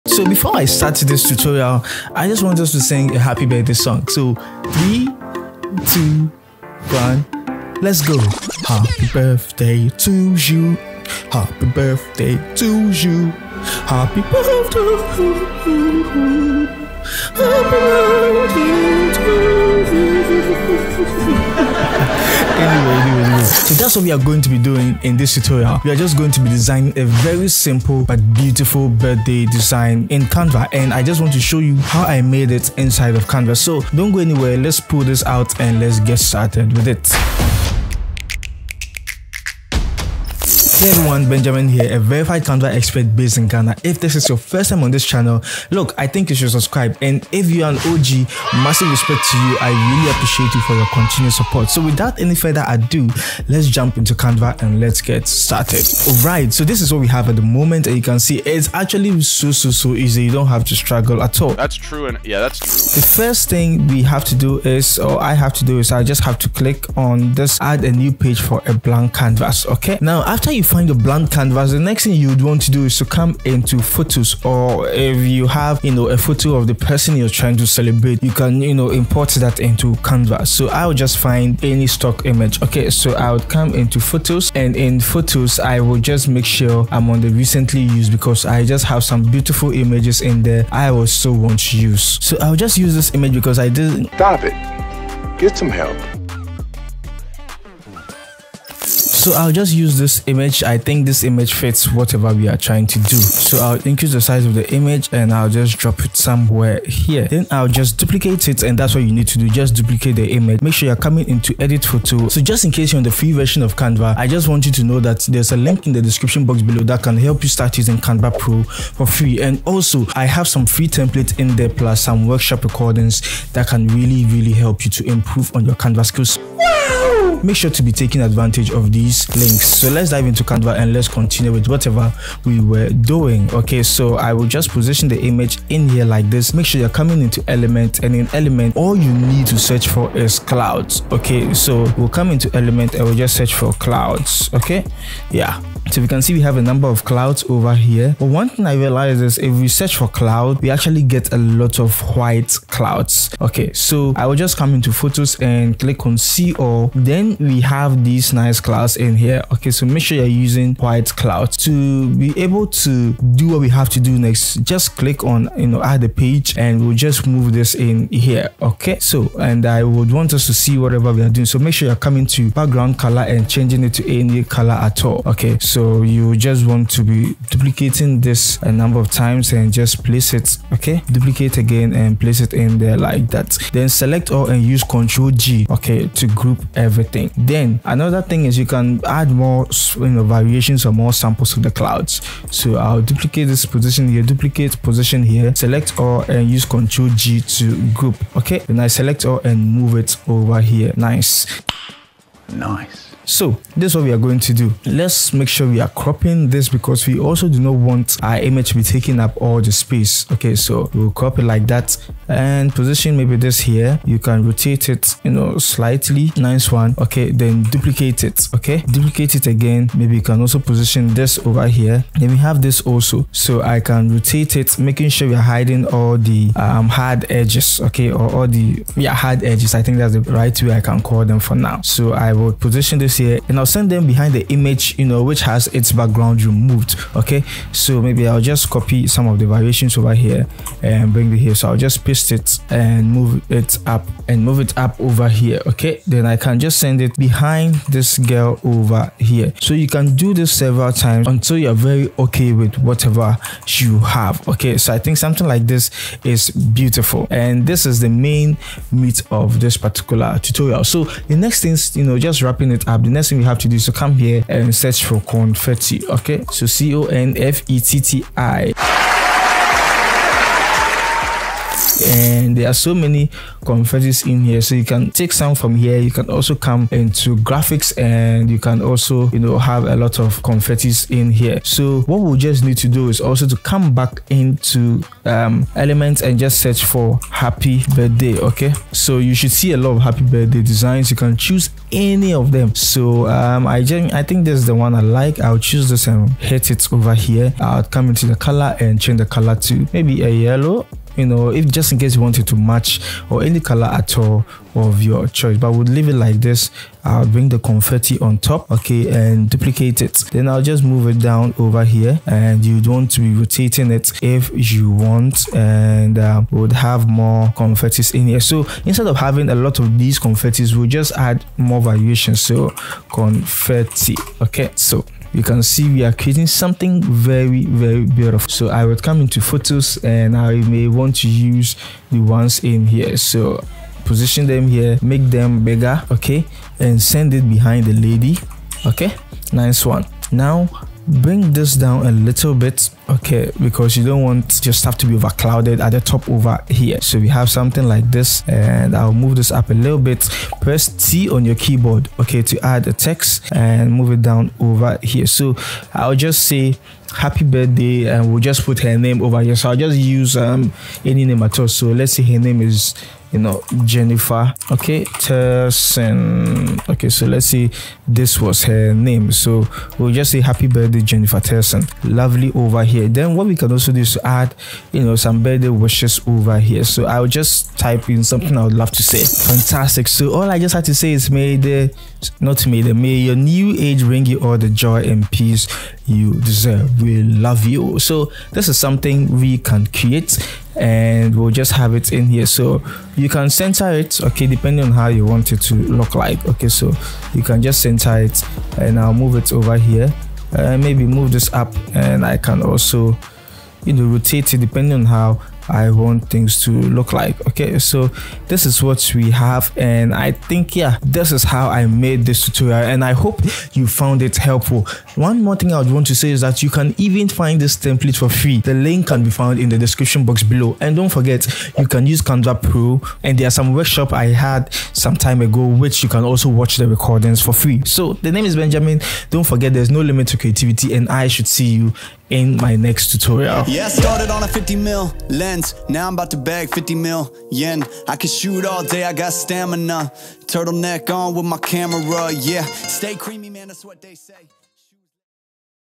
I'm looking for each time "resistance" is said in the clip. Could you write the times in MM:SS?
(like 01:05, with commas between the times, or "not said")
not said.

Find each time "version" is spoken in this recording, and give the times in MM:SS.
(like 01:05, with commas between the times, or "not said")
01:53.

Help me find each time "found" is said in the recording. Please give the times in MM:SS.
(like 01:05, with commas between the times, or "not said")
06:53, 06:59.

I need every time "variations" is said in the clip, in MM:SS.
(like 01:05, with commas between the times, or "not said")
03:10, 03:59, 05:21.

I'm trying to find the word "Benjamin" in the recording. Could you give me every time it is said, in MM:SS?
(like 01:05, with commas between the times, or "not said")
00:41, 07:08.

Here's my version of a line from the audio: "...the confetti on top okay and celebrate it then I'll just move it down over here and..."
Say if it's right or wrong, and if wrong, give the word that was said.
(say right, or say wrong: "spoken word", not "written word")
wrong: "duplicate", not "celebrate".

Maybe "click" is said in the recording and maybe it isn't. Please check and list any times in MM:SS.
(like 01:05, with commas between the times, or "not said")
01:06, 02:35, 02:44.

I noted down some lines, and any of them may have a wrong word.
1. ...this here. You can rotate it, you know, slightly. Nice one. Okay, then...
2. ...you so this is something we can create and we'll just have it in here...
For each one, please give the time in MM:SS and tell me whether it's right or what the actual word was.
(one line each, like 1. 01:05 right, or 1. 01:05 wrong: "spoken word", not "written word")
1. 03:33 right
2. 06:27 right.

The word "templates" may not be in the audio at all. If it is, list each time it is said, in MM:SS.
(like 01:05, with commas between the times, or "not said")
02:00, 06:57.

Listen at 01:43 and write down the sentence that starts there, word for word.
So I'll increase the size of the image and I'll just drop it somewhere here.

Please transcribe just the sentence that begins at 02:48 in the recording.
Okay, so, and I would want us to see whatever we are doing.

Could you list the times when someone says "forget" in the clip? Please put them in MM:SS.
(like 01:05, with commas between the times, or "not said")
07:01, 07:09.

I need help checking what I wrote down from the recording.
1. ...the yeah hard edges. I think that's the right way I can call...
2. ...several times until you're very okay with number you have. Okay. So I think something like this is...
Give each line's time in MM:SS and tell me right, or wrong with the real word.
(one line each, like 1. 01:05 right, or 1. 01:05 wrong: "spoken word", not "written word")
1. 03:48 right
2. 04:10 wrong: "whatever", not "number".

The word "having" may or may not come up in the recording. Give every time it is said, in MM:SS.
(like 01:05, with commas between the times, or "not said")
05:19.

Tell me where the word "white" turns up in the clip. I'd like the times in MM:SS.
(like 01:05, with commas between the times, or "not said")
02:32, 02:40.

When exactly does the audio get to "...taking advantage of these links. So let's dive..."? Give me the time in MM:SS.
02:07.